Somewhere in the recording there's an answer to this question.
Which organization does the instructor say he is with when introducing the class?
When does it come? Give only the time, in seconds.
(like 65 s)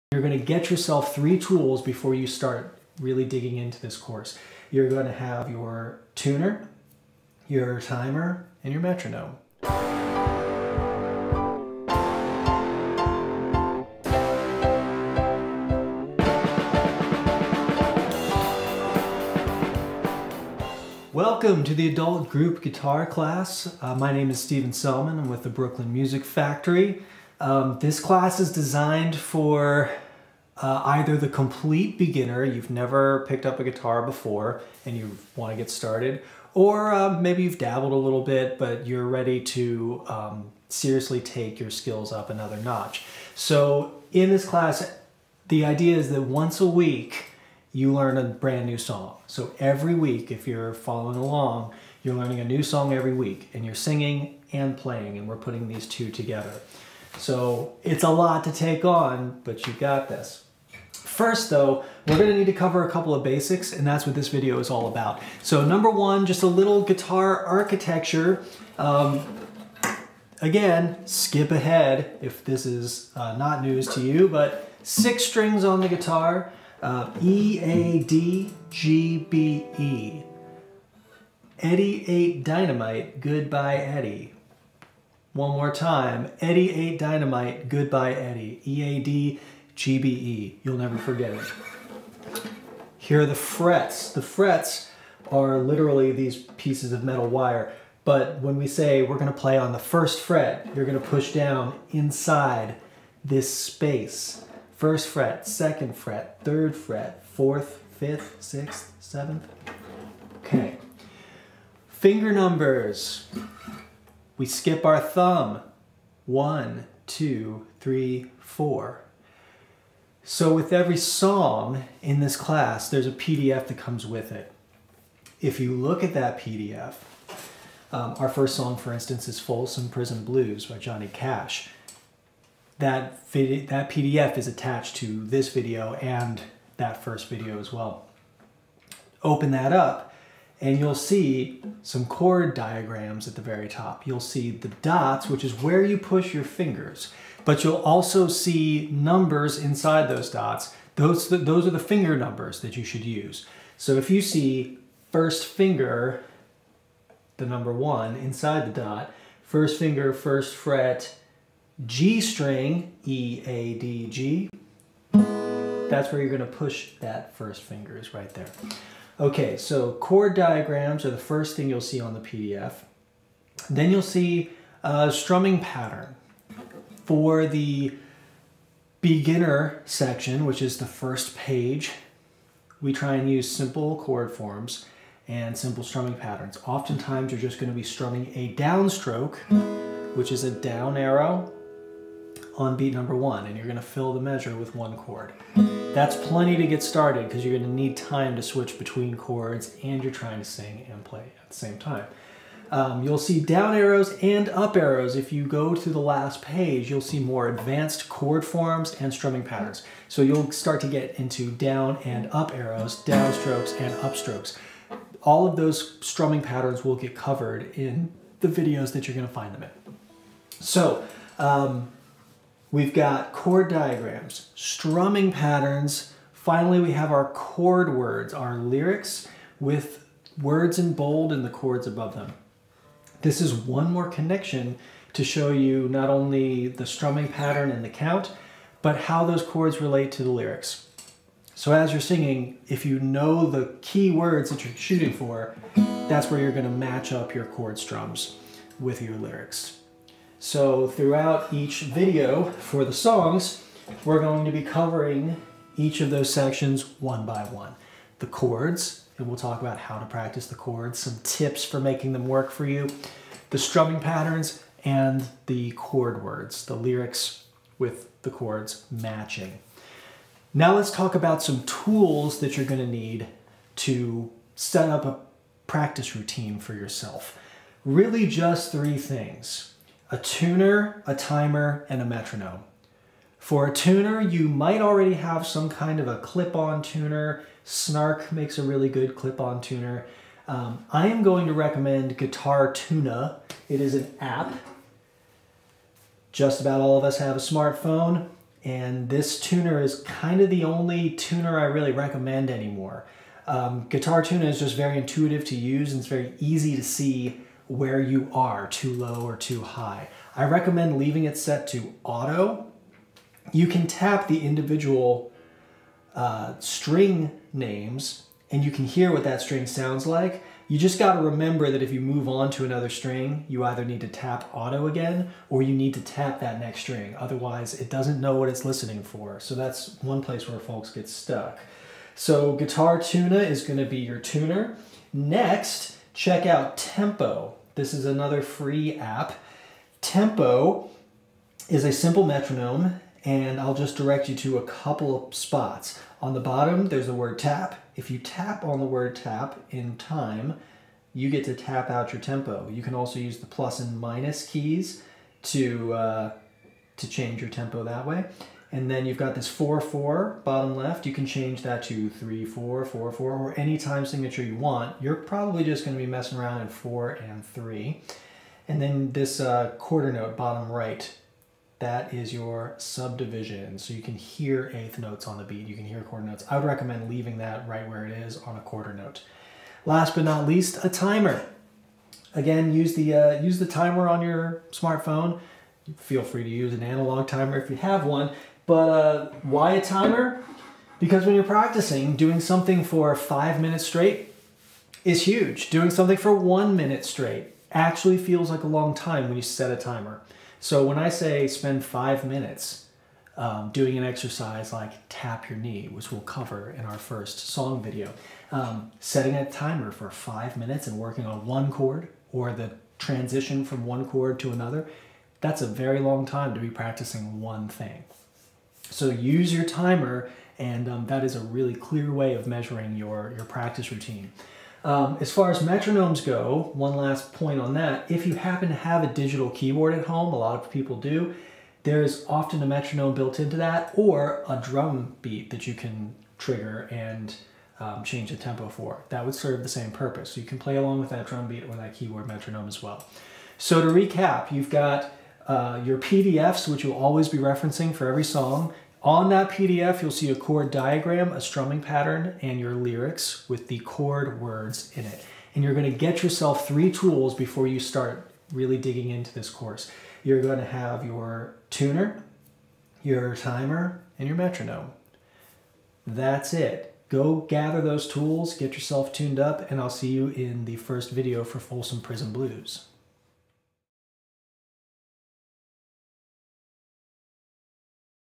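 25 s.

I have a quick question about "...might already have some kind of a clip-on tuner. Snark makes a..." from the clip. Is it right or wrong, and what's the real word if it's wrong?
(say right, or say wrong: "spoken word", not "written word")
right.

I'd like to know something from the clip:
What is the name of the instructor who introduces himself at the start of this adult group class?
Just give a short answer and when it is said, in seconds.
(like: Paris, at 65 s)
Stephen Selman, at 24 s.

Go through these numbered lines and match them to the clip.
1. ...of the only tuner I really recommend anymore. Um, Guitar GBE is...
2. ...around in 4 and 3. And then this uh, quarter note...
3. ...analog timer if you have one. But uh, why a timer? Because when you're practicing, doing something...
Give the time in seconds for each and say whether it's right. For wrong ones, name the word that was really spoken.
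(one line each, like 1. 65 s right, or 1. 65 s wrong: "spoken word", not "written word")
1. 300 s wrong: "Tuna", not "GBE"
2. 366 s right
3. 386 s right.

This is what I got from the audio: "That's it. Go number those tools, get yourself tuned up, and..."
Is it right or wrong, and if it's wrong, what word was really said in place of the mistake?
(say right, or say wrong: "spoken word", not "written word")
wrong: "gather", not "number".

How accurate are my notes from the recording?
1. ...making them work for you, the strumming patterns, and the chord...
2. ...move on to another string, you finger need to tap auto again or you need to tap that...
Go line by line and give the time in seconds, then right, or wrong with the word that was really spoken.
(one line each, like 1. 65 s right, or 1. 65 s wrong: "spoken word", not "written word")
1. 261 s right
2. 321 s wrong: "either", not "finger".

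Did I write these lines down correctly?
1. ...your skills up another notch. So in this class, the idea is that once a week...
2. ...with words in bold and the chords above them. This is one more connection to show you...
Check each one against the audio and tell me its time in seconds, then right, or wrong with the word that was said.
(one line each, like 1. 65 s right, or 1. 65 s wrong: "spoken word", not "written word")
1. 41 s right
2. 229 s right.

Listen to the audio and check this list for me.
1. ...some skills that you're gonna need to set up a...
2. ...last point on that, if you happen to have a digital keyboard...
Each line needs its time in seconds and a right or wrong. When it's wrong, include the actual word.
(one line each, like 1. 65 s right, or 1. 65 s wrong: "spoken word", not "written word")
1. 271 s wrong: "tools", not "skills"
2. 426 s right.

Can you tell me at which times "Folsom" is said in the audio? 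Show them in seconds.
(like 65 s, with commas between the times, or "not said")
129 s, 471 s.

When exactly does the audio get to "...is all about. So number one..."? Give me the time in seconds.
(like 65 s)
64 s.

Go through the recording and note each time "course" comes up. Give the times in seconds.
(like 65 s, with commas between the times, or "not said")
3 s, 459 s.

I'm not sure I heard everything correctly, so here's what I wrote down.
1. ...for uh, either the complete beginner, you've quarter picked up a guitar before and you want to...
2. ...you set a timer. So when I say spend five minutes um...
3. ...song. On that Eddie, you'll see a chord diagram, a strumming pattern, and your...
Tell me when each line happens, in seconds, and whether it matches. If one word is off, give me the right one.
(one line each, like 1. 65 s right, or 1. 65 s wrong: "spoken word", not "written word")
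1. 29 s wrong: "never", not "quarter"
2. 399 s right
3. 448 s wrong: "PDF", not "Eddie".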